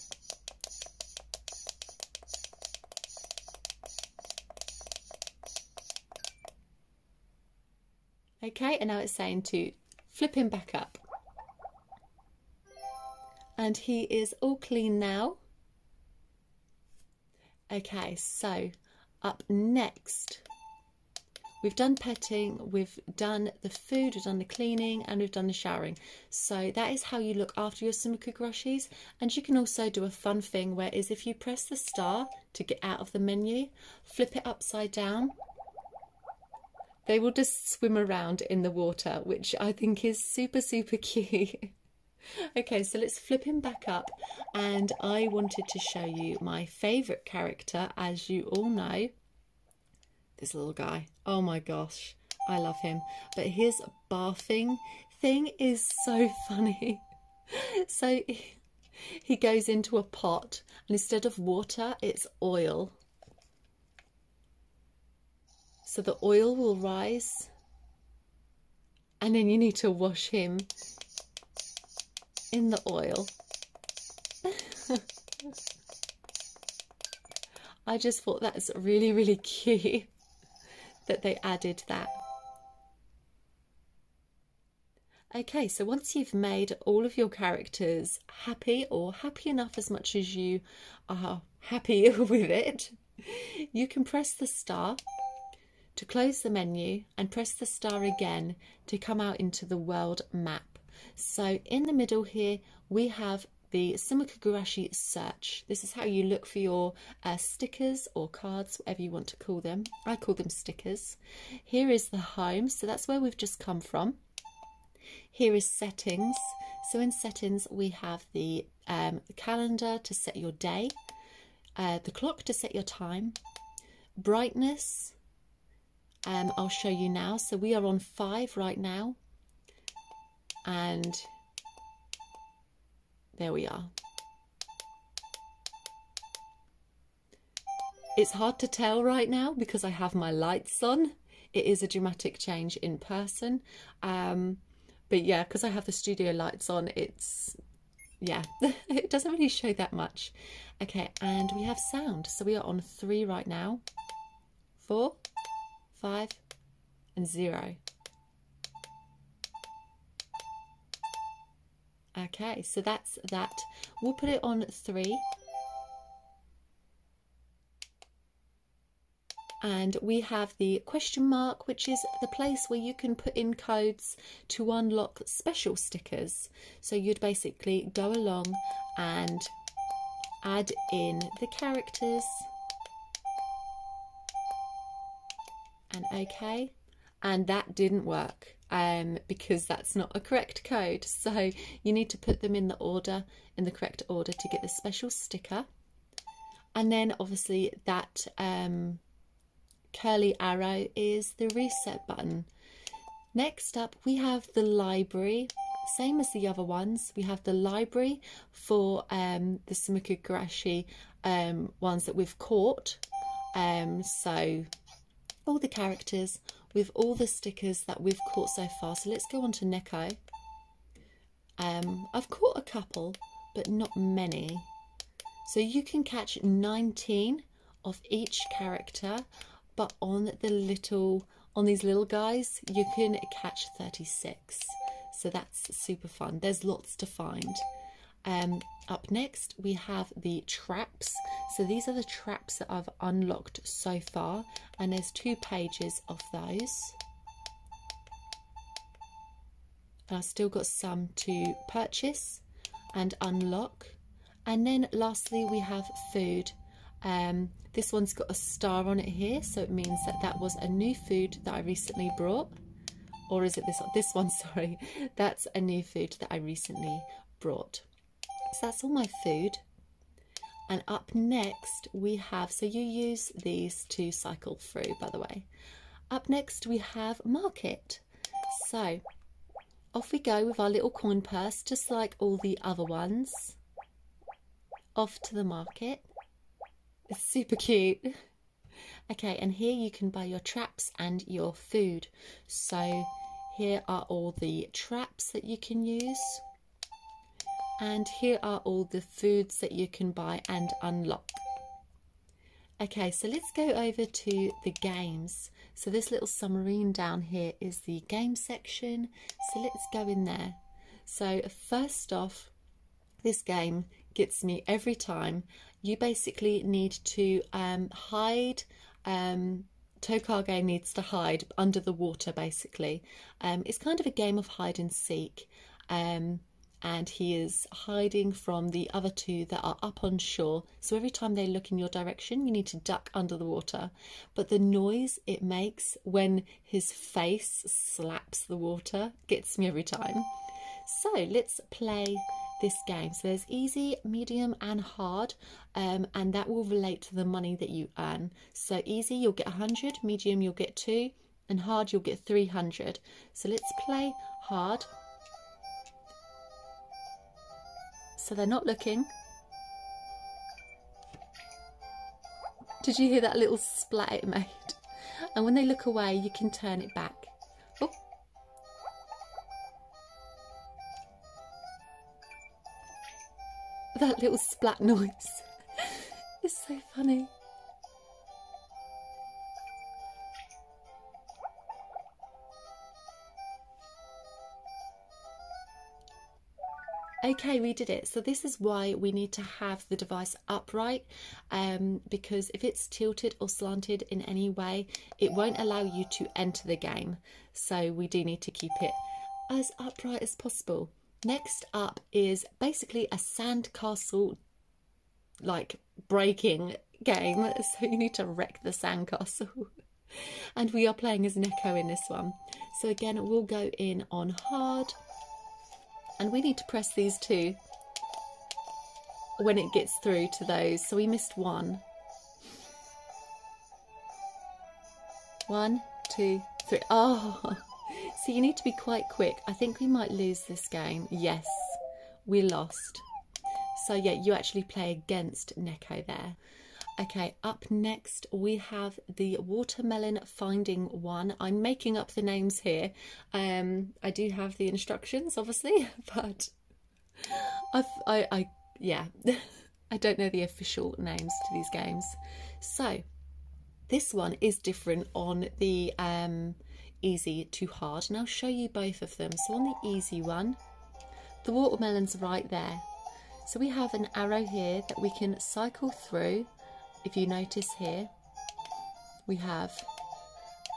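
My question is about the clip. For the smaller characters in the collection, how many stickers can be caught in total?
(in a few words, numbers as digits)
36.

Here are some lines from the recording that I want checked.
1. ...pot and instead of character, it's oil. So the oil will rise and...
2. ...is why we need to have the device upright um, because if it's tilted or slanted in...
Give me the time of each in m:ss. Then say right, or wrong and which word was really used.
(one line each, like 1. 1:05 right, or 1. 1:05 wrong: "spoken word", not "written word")
1. 1:00 wrong: "water", not "character"
2. 6:28 right.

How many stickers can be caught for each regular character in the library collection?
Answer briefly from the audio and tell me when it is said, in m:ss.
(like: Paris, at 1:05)
19, at 3:46.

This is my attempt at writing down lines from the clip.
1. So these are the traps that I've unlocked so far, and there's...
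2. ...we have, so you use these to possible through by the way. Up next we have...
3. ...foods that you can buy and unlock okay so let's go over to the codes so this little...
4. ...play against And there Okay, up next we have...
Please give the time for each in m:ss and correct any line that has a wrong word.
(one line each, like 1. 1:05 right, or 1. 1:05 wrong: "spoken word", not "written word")
1. 4:01 right
2. 4:31 wrong: "cycle", not "possible"
3. 4:59 wrong: "games", not "codes"
4. 7:14 wrong: "Neko", not "And".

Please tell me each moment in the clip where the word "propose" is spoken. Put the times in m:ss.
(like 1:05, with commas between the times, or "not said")
not said.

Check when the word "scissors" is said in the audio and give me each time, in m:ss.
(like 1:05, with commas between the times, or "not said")
not said.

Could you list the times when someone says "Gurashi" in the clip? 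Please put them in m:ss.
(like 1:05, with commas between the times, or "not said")
1:44, 3:30.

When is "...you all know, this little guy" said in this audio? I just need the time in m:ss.
0:48.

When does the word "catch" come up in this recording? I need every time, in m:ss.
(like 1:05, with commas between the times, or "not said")
3:46, 3:53.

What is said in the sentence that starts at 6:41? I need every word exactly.
Next up is basically a sandcastle like breaking game.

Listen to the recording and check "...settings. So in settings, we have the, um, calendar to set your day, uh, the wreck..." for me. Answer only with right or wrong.
wrong.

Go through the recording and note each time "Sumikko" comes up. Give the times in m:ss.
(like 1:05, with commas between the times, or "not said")
0:27, 1:43, 3:29.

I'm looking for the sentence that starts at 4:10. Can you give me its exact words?
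And I've still got some to purchase and unlock.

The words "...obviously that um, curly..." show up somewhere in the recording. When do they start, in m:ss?
3:17.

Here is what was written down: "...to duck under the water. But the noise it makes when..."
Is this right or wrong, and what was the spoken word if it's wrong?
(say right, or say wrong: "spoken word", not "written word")
right.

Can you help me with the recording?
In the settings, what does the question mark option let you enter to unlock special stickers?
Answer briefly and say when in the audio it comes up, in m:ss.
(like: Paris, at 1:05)
Codes, at 2:53.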